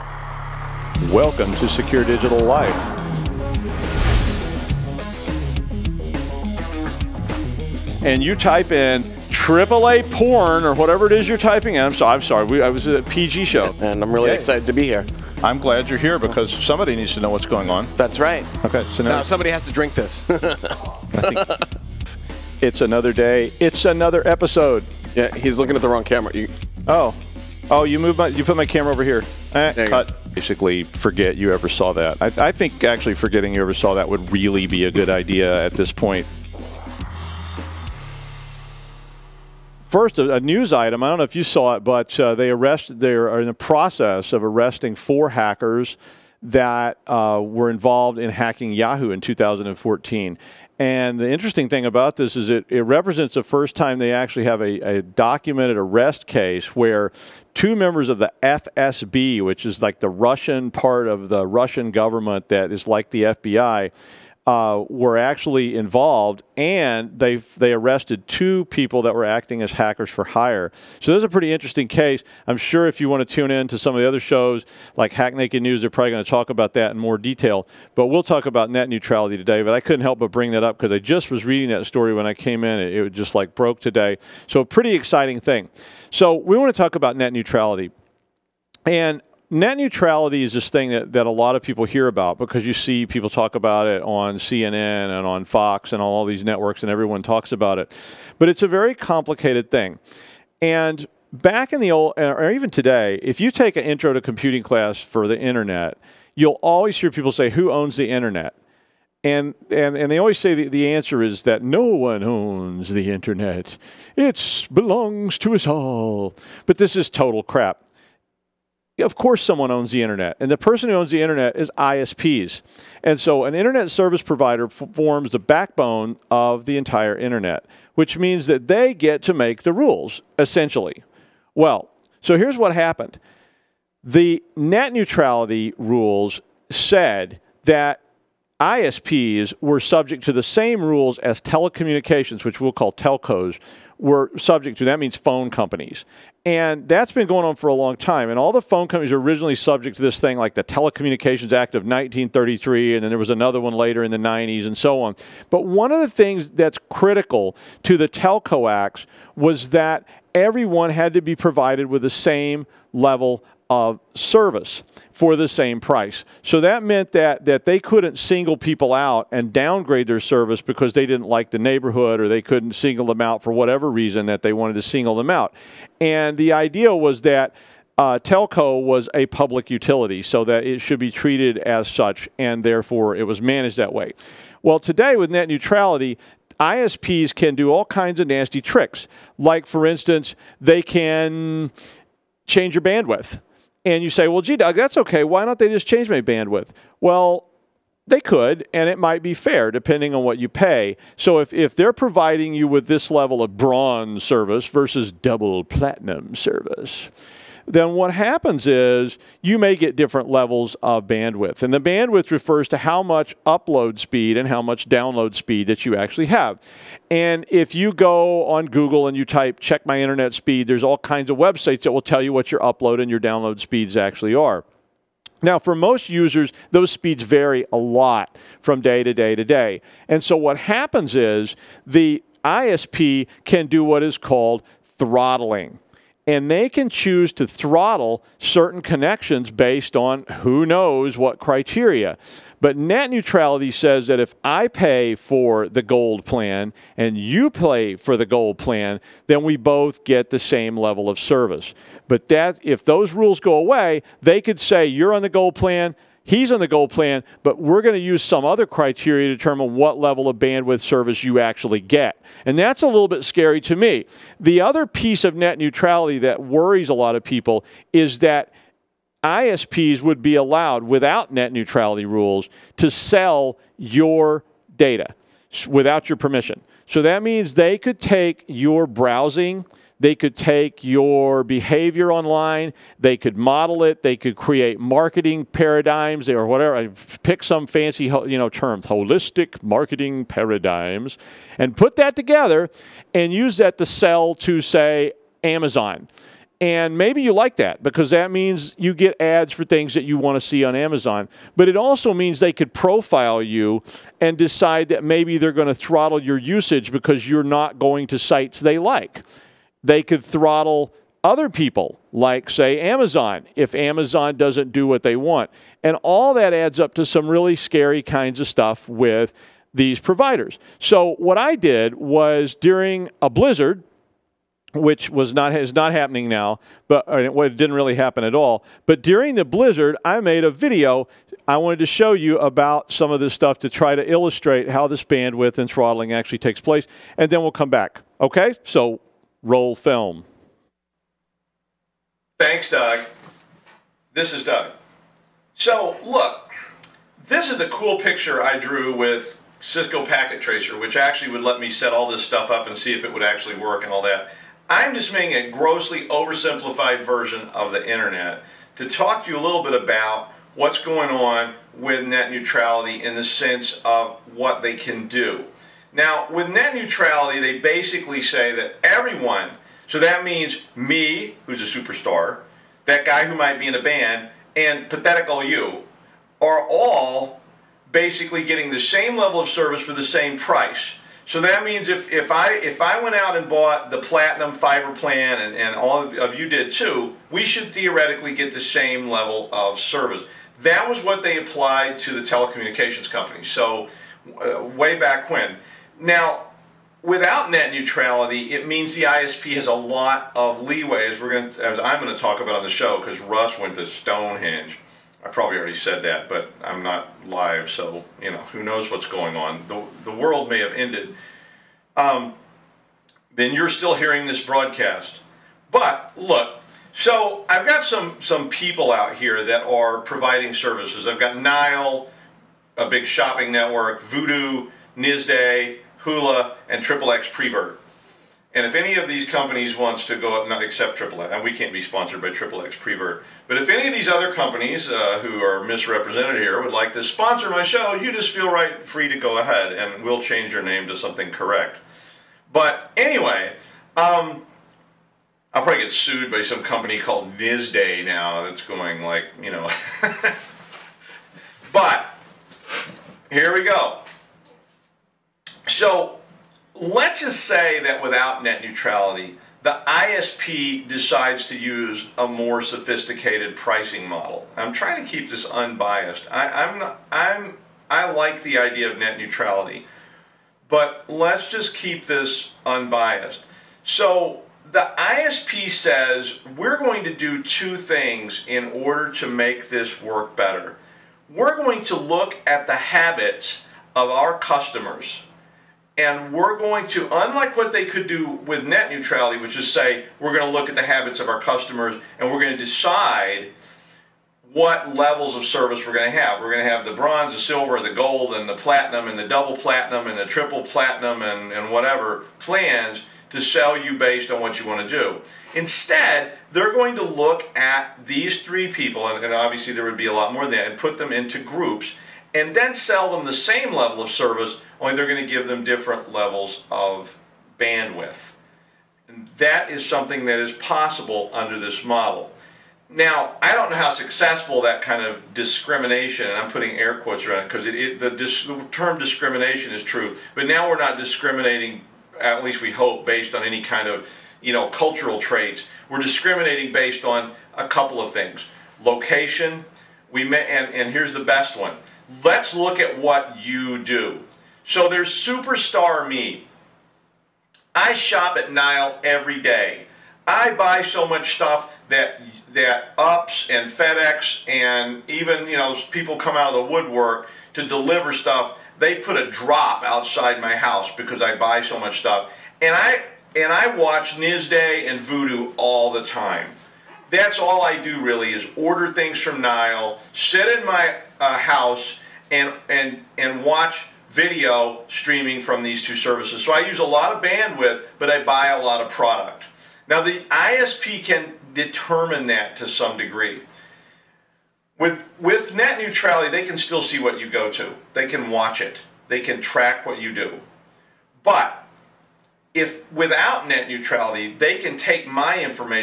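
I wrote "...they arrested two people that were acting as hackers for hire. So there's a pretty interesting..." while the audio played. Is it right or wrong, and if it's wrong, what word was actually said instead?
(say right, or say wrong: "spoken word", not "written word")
right.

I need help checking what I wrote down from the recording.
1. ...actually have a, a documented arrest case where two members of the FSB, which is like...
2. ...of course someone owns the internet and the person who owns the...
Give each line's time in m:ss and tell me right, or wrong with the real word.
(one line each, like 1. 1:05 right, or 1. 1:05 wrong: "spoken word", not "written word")
1. 0:54 right
2. 1:58 right.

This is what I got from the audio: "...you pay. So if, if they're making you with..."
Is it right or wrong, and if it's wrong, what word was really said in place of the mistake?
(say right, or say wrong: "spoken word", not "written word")
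wrong: "providing", not "making".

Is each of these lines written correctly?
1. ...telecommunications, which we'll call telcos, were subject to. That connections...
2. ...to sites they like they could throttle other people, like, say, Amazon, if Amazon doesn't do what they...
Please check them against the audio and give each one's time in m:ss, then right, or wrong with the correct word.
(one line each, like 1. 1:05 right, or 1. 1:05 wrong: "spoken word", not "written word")
1. 2:21 wrong: "means", not "connections"
2. 5:08 right.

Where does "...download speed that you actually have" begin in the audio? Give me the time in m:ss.
3:34.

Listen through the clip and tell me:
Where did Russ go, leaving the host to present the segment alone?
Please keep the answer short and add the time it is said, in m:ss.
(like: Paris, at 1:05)
Stonehenge, at 6:43.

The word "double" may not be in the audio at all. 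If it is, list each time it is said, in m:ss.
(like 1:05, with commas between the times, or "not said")
3:25, 8:19.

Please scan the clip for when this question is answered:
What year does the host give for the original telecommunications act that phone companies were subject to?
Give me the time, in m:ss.
2:31.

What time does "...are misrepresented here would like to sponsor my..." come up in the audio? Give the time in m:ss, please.
7:15.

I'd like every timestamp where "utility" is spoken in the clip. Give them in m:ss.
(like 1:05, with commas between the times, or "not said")
2:59.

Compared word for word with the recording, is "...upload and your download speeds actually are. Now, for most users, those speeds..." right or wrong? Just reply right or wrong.
right.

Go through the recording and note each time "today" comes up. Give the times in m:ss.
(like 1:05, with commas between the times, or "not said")
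1:19, 1:23, 1:42, 3:04.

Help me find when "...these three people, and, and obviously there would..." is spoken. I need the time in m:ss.
8:28.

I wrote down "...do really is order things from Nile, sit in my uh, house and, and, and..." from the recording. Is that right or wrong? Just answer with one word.
right.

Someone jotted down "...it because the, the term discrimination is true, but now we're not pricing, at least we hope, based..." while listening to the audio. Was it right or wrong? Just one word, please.
wrong.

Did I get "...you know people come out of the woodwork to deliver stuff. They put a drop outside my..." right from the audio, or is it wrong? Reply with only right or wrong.
right.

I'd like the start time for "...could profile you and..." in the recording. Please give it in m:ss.
5:02.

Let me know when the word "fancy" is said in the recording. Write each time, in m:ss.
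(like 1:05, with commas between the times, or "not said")
4:47.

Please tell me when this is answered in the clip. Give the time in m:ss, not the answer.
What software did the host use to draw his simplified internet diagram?
5:49.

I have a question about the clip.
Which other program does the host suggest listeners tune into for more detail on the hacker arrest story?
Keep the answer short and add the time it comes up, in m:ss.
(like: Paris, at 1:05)
Hack Naked News, at 1:15.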